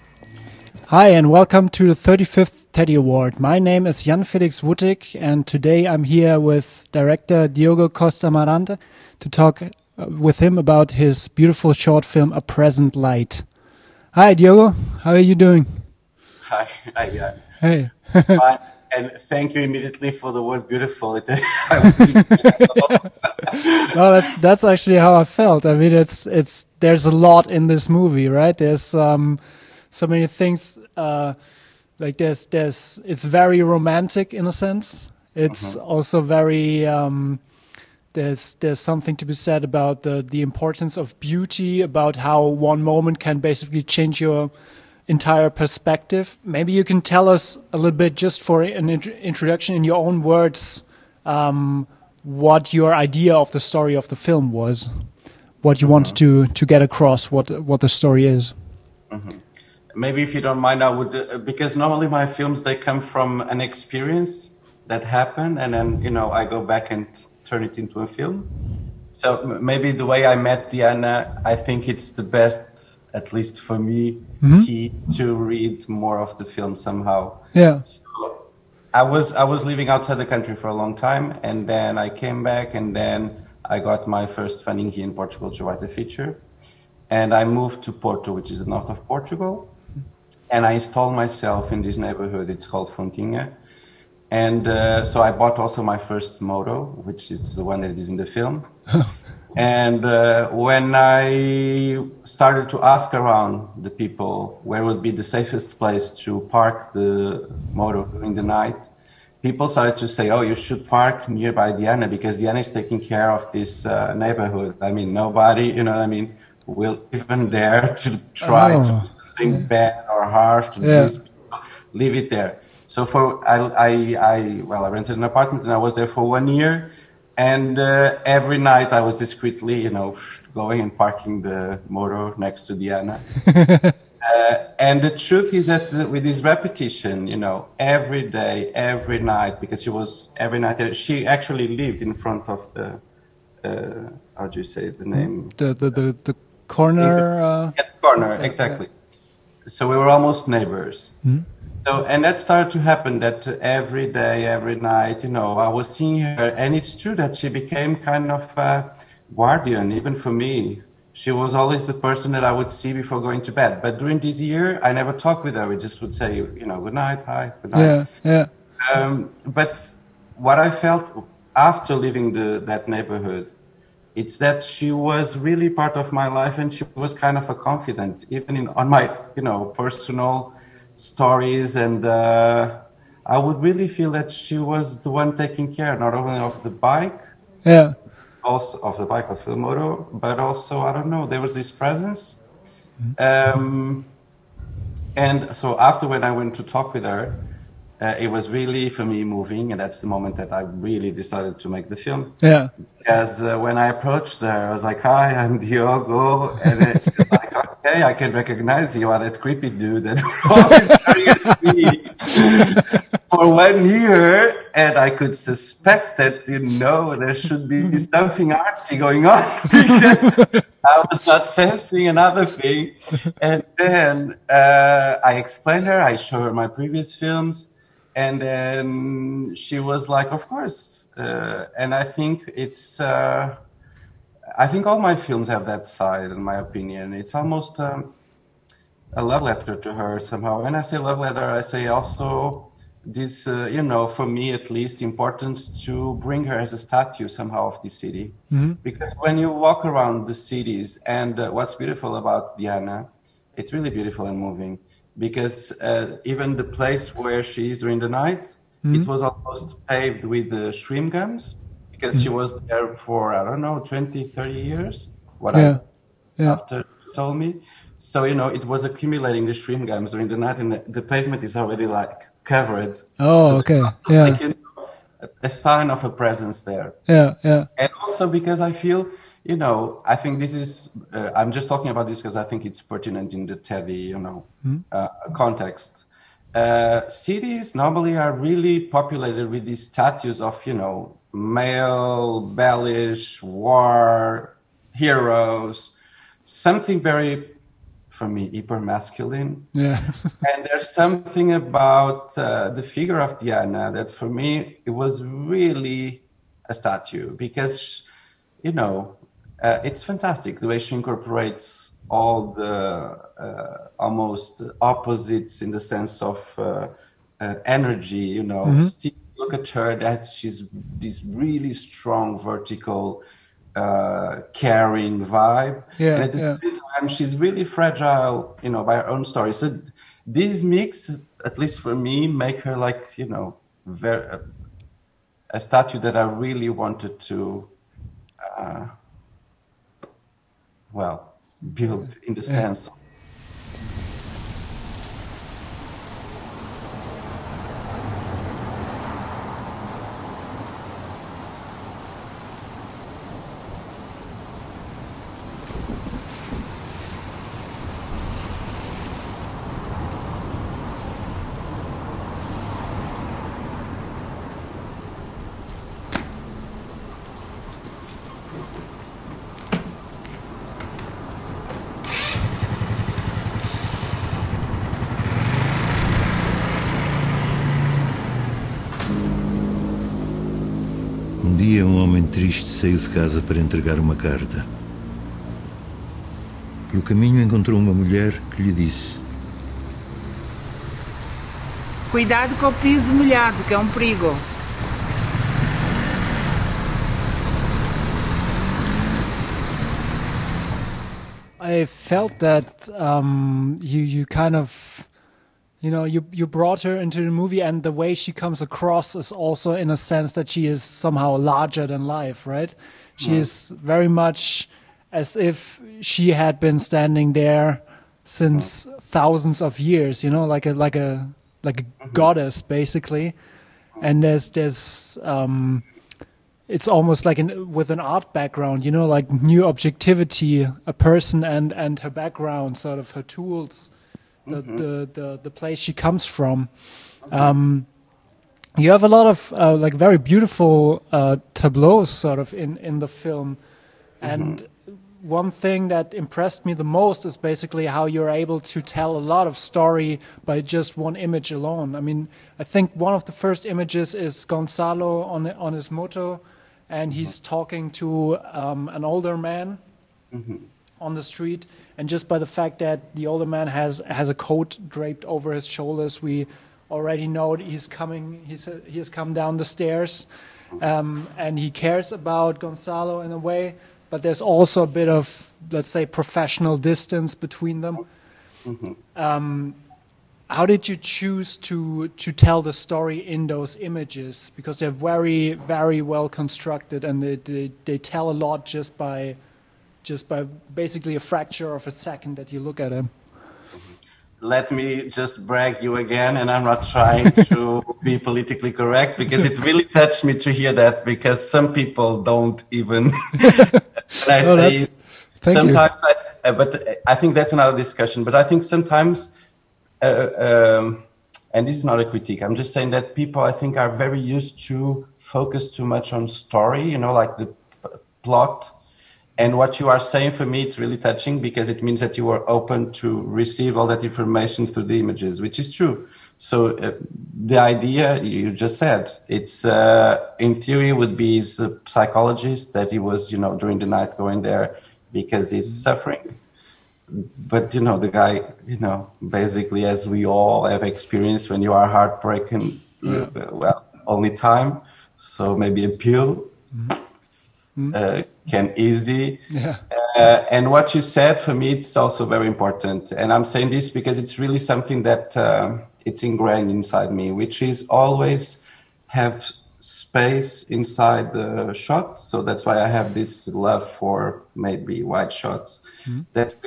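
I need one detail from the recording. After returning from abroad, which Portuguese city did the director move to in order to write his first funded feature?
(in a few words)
Porto.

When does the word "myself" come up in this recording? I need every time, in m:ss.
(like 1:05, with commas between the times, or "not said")
1:31.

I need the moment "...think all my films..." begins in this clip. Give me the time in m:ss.
3:54.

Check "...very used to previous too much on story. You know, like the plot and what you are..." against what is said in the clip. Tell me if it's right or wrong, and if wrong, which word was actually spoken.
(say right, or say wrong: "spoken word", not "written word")
wrong: "focus", not "previous".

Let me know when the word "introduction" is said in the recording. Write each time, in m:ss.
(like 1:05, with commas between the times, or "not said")
0:49.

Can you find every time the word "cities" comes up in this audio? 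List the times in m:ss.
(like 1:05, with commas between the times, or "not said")
4:10, 4:47.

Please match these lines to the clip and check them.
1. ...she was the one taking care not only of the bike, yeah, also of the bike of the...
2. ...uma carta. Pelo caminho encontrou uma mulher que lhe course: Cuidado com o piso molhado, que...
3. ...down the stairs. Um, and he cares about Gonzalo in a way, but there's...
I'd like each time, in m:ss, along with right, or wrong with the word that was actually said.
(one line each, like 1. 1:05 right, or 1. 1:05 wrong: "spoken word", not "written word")
1. 3:04 right
2. 6:23 wrong: "disse", not "course"
3. 7:49 right.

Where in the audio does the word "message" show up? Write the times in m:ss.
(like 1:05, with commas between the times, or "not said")
not said.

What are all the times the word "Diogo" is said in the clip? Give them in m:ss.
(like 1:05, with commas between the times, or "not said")
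0:07, 0:14, 3:25.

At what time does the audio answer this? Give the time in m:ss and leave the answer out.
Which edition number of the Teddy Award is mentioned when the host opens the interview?
0:01.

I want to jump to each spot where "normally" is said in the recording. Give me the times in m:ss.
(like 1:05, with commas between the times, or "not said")
1:01, 4:47.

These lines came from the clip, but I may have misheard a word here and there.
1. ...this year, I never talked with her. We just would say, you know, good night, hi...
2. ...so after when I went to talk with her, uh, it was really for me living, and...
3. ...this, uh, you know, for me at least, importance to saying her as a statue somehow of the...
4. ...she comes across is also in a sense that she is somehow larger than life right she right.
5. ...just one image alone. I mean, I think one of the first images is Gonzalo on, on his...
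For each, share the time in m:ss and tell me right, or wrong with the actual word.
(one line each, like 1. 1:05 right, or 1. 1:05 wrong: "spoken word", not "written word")
1. 2:44 right
2. 3:15 wrong: "moving", not "living"
3. 4:03 wrong: "bring", not "saying"
4. 6:48 right
5. 7:30 right.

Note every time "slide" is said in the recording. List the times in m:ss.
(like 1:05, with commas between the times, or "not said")
not said.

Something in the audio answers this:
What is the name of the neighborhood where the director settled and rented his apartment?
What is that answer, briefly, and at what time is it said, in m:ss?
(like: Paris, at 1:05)
Fontinha, at 1:32.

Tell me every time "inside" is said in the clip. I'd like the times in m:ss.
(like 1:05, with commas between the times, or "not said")
9:16, 9:20.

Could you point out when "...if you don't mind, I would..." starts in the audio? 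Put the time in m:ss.
1:00.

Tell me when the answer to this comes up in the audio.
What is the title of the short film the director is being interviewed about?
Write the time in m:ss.
0:12.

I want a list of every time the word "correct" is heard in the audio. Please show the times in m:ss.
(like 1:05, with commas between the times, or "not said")
8:18.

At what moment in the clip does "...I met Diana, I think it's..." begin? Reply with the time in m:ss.
1:10.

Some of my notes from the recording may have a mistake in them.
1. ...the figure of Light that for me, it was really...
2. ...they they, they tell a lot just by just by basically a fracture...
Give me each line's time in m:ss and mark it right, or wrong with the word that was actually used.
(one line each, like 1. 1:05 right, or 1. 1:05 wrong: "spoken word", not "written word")
1. 5:02 wrong: "Diana", not "Light"
2. 8:07 right.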